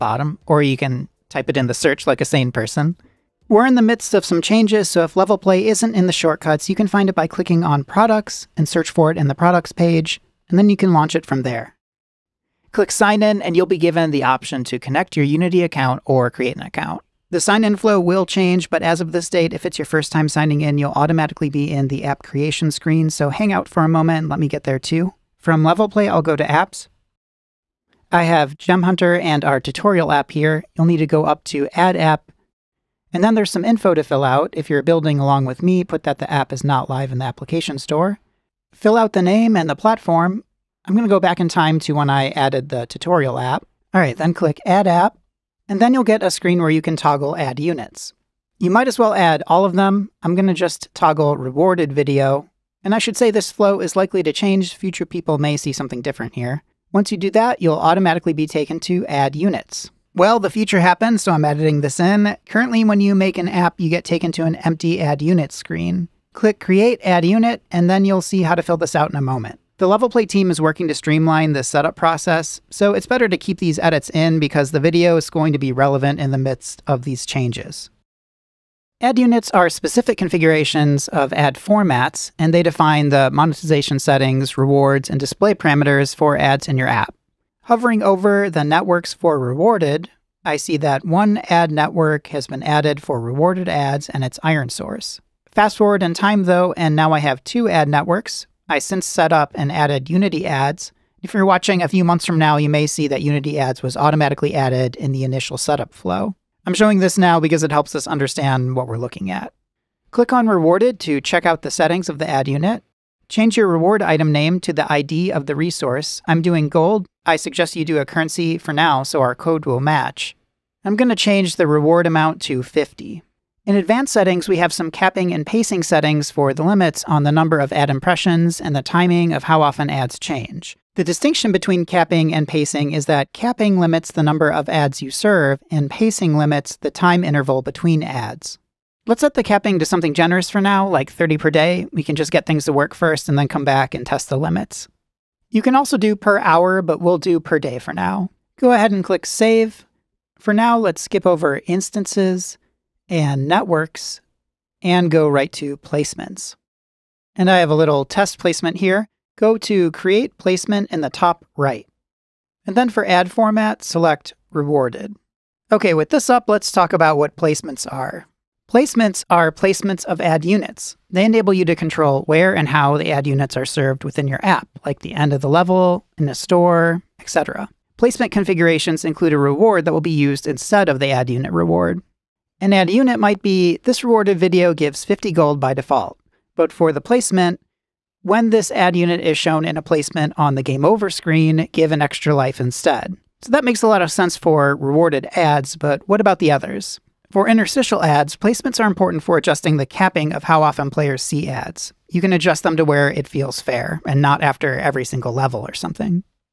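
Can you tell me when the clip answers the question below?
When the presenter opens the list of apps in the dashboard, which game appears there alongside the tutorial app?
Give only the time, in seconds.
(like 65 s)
28 s.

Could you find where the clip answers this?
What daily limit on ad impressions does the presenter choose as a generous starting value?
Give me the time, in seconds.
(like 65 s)
141 s.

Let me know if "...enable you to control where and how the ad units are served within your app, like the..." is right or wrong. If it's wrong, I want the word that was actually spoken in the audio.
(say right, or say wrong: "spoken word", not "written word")
right.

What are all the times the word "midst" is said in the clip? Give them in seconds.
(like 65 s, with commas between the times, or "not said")
3 s, 76 s.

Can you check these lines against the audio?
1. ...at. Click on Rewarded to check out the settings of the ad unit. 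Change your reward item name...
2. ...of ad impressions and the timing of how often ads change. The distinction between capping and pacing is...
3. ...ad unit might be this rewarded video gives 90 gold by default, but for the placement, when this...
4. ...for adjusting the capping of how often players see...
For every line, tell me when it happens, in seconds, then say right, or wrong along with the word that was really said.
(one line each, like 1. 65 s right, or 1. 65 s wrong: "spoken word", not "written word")
1. 109 s right
2. 127 s right
3. 182 s wrong: "50", not "90"
4. 199 s right.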